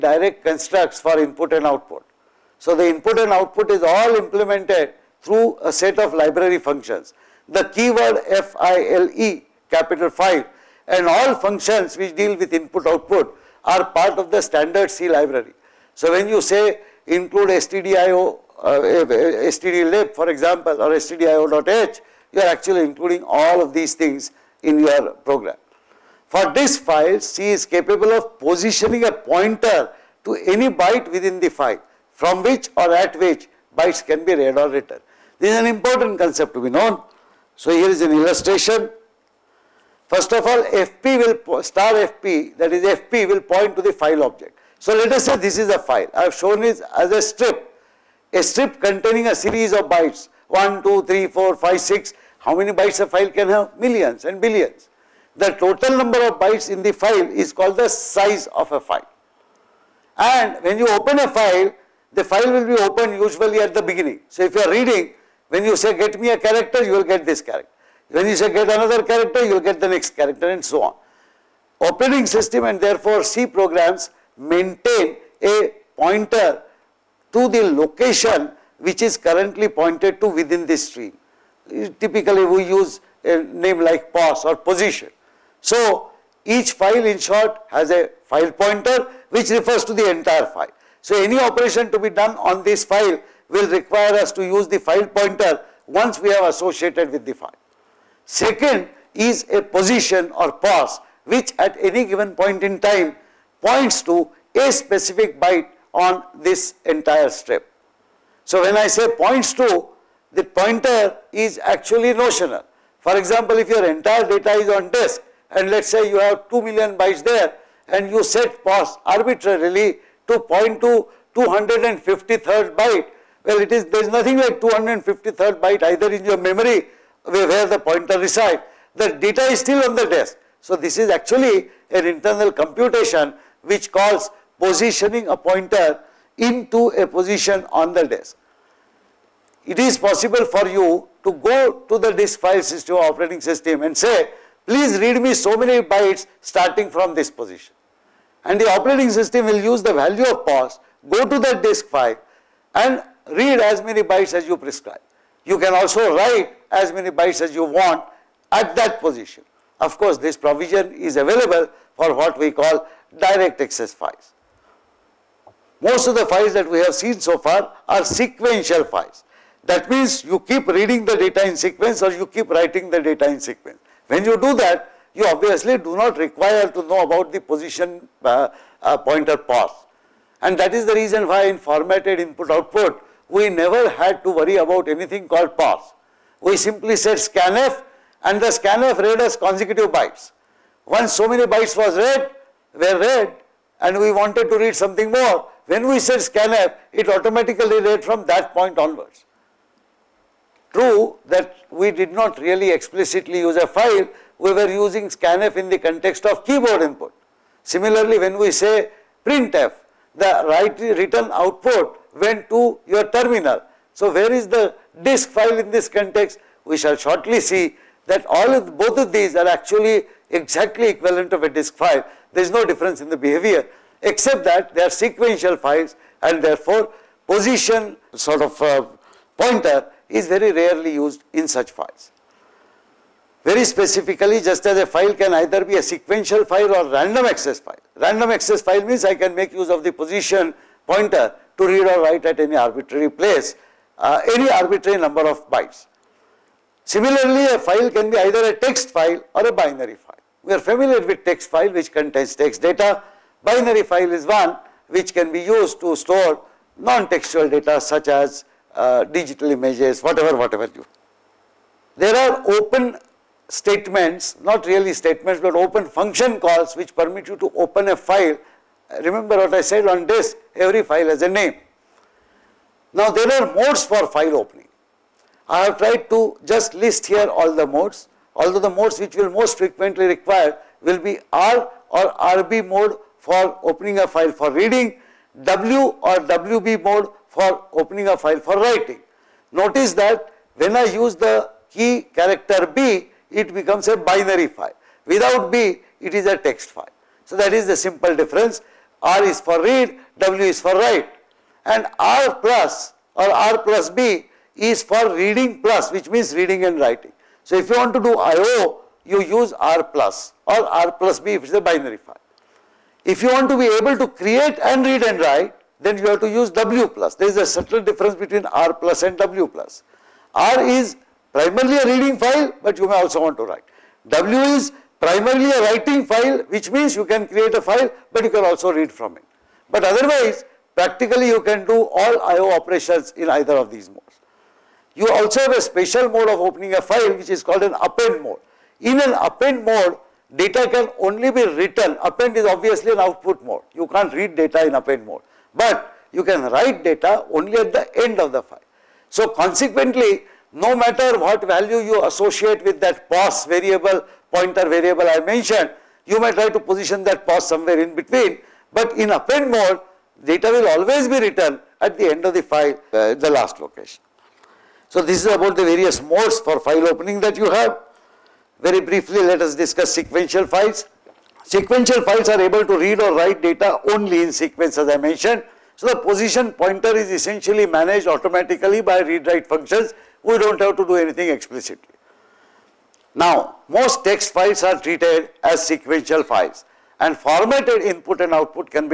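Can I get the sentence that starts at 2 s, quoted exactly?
So the input and output is all implemented through a set of library functions.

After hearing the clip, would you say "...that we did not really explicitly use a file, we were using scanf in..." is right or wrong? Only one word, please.
right.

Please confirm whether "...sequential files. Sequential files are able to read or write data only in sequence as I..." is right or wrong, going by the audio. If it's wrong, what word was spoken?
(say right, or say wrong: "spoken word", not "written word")
right.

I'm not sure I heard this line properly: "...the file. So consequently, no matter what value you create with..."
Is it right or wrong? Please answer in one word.
wrong.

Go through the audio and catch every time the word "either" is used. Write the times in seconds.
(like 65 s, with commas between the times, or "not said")
125 s, 235 s, 248 s, 333 s.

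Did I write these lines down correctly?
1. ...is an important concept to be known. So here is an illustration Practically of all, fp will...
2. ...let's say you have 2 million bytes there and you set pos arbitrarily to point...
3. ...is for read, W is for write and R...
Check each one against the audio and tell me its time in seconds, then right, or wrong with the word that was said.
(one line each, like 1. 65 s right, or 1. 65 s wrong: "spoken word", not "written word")
1. 35 s wrong: "First", not "Practically"
2. 115 s right
3. 299 s right.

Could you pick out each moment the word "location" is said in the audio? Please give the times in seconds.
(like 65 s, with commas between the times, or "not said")
77 s, 363 s.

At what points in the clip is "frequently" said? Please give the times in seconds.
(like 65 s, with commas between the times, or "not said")
279 s.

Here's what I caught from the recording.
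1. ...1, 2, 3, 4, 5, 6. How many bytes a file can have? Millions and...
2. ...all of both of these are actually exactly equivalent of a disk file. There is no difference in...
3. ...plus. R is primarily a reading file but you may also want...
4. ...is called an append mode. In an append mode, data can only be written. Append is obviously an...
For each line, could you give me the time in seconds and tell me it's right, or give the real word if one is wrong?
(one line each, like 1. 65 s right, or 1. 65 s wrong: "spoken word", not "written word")
1. 50 s right
2. 218 s right
3. 319 s right
4. 337 s right.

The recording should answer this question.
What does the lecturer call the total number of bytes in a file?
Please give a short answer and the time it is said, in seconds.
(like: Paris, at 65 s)
size of a file, at 57 s.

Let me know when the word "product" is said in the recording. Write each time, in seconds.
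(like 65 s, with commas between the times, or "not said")
not said.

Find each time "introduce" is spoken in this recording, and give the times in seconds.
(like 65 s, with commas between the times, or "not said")
not said.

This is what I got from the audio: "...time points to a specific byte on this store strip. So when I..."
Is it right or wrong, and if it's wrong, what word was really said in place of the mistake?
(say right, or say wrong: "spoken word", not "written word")
wrong: "entire", not "store".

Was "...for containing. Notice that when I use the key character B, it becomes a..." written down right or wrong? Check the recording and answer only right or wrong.
wrong.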